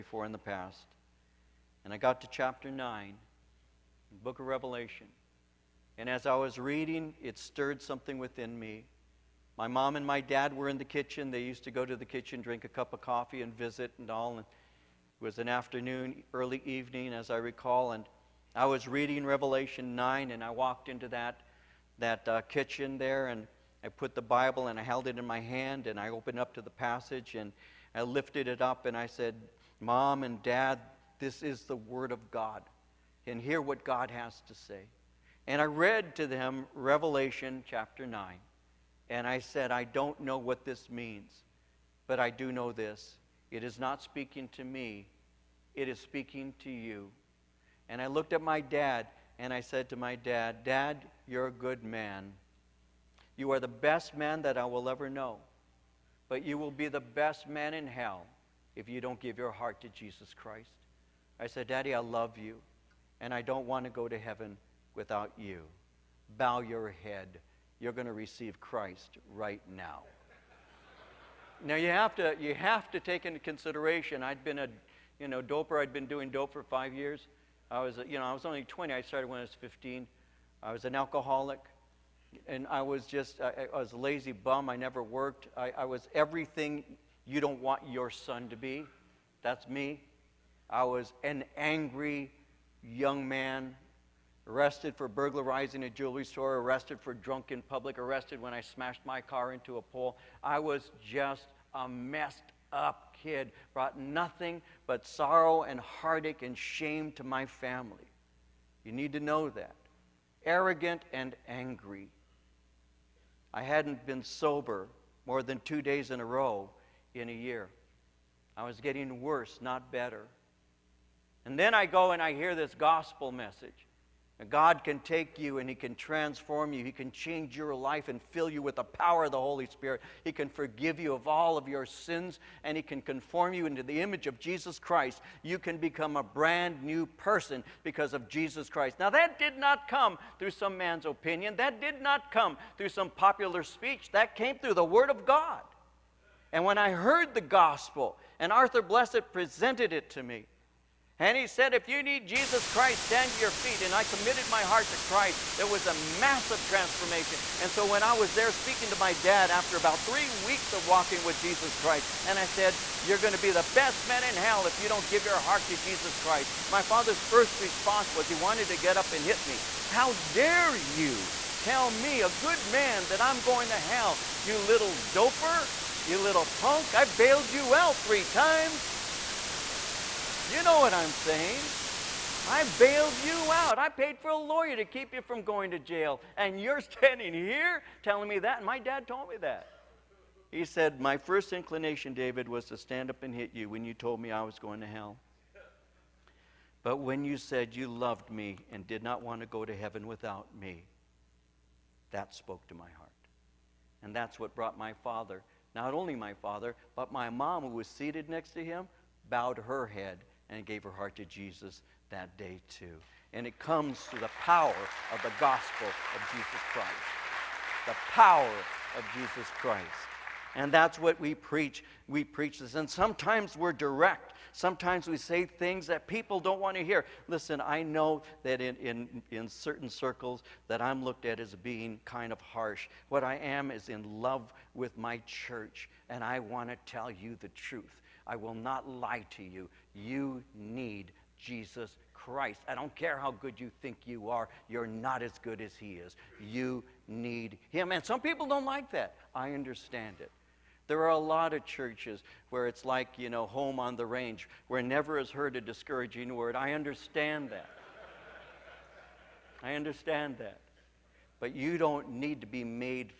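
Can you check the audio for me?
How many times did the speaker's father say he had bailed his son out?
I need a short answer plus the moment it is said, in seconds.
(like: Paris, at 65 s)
3, at 178 s.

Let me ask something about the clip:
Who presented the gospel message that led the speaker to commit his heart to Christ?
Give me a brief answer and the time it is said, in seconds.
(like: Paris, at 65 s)
Arthur Blessitt, at 148 s.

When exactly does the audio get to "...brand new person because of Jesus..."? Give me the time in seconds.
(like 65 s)
136 s.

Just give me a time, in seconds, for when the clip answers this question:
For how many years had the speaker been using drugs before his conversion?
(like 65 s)
76 s.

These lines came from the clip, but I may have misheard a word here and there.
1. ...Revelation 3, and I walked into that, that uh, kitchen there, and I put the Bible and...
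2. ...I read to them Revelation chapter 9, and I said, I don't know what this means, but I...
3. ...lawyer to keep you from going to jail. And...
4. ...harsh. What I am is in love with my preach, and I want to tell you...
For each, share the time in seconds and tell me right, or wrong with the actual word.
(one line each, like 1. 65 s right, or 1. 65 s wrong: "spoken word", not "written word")
1. 19 s wrong: "9", not "3"
2. 35 s right
3. 184 s right
4. 232 s wrong: "church", not "preach".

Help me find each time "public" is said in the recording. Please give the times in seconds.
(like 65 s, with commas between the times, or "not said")
97 s.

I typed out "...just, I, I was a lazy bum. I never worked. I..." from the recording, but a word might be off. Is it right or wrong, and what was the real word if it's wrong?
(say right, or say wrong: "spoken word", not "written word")
right.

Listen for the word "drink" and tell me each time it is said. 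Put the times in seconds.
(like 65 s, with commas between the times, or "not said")
12 s.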